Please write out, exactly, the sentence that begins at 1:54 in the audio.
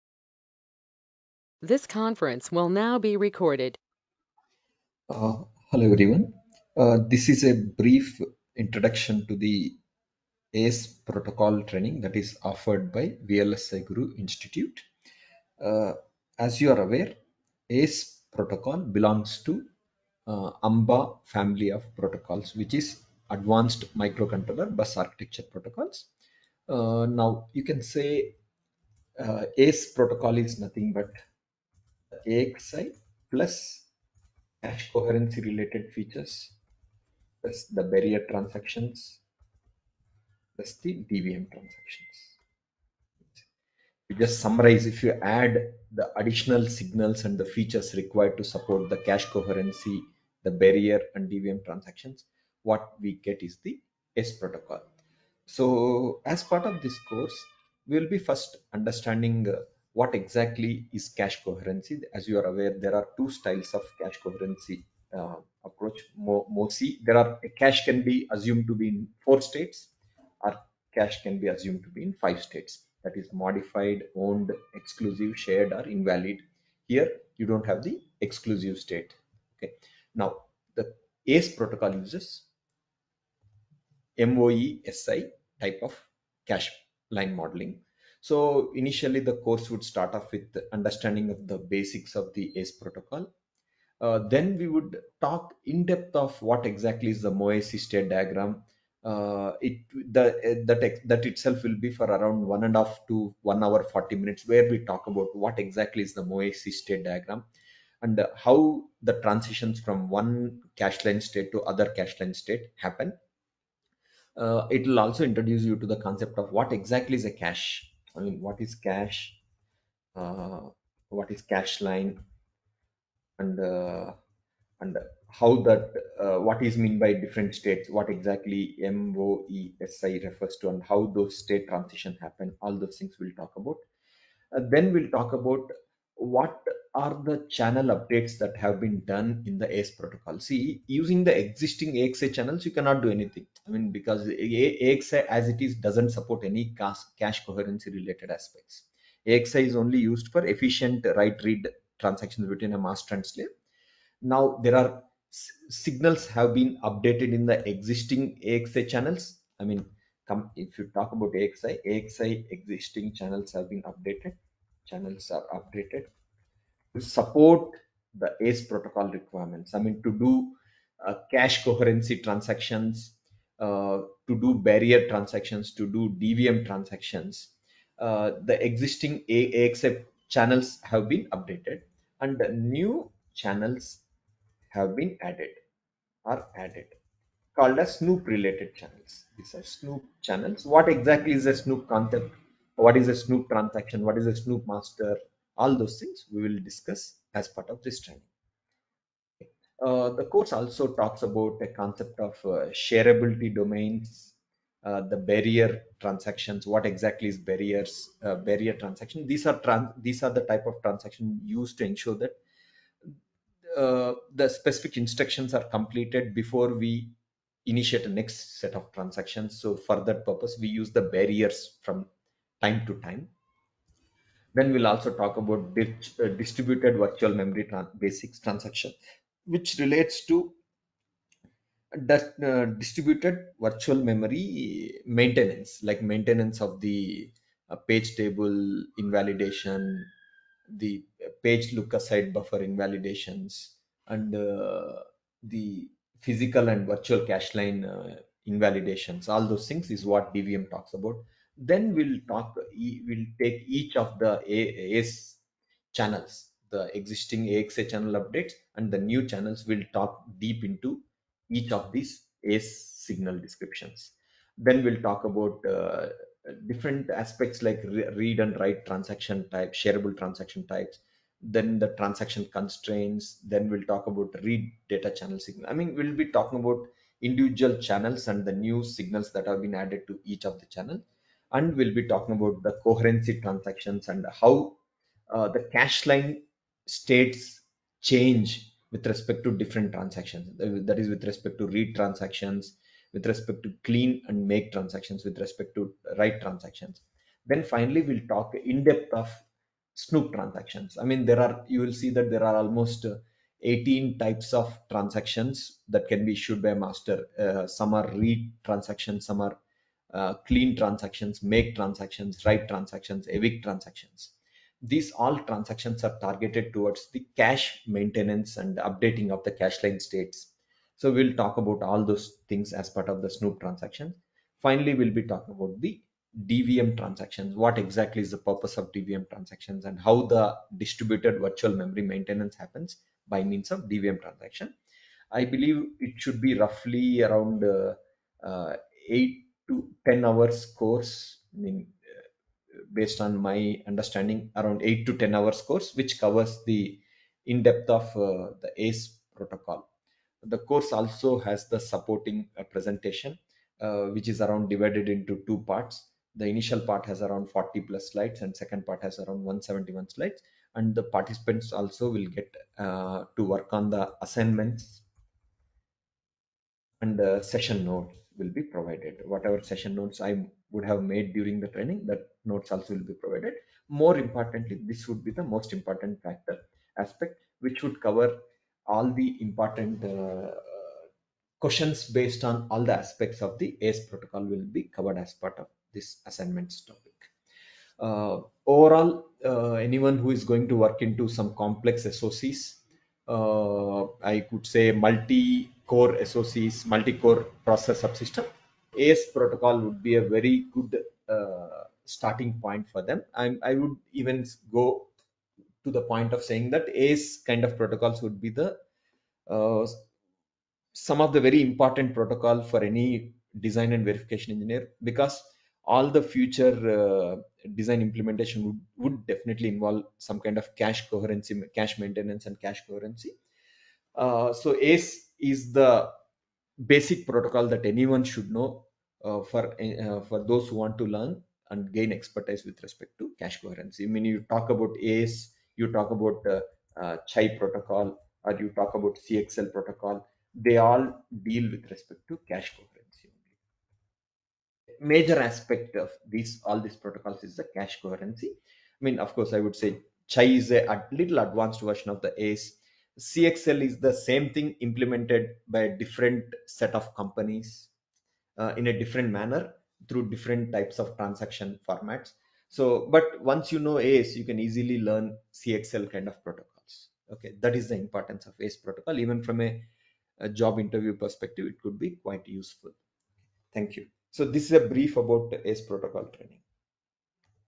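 Uh, it will also introduce you to the concept of what exactly is a cache I mean, what is cache?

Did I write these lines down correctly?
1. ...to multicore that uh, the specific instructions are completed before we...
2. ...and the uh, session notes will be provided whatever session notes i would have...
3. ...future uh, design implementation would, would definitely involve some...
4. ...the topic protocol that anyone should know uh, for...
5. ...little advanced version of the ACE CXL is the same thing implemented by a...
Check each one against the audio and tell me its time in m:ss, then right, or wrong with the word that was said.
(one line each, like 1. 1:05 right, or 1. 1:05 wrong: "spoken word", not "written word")
1. 3:31 wrong: "ensure", not "multicore"
2. 6:07 right
3. 6:56 right
4. 7:05 wrong: "basic", not "topic"
5. 7:31 right.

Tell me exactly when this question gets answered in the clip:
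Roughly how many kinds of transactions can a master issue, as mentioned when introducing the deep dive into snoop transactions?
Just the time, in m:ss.
5:03.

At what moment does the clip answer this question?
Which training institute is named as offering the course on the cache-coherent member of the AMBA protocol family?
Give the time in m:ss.
0:13.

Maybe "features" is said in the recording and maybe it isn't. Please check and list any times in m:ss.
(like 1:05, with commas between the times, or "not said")
0:35, 0:47.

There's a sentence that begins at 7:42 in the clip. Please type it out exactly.
So, but once you know ACE, you can easily learn CXL kind of protocols.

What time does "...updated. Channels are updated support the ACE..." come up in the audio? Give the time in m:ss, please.
2:43.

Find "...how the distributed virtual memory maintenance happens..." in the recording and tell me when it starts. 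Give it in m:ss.
5:29.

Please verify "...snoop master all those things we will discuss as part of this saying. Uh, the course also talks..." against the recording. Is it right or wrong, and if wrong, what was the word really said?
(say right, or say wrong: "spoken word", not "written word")
wrong: "training", not "saying".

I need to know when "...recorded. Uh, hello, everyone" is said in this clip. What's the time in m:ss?
0:03.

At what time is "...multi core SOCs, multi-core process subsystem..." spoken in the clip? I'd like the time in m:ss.
6:34.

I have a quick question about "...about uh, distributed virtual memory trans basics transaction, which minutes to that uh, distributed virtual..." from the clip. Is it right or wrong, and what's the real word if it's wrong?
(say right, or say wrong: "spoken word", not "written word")
wrong: "relates", not "minutes".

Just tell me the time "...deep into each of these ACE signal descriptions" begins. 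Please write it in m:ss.
4:20.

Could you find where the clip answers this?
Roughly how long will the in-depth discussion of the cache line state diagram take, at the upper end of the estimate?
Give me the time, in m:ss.
1:43.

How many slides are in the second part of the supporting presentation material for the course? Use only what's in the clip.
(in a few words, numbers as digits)
171.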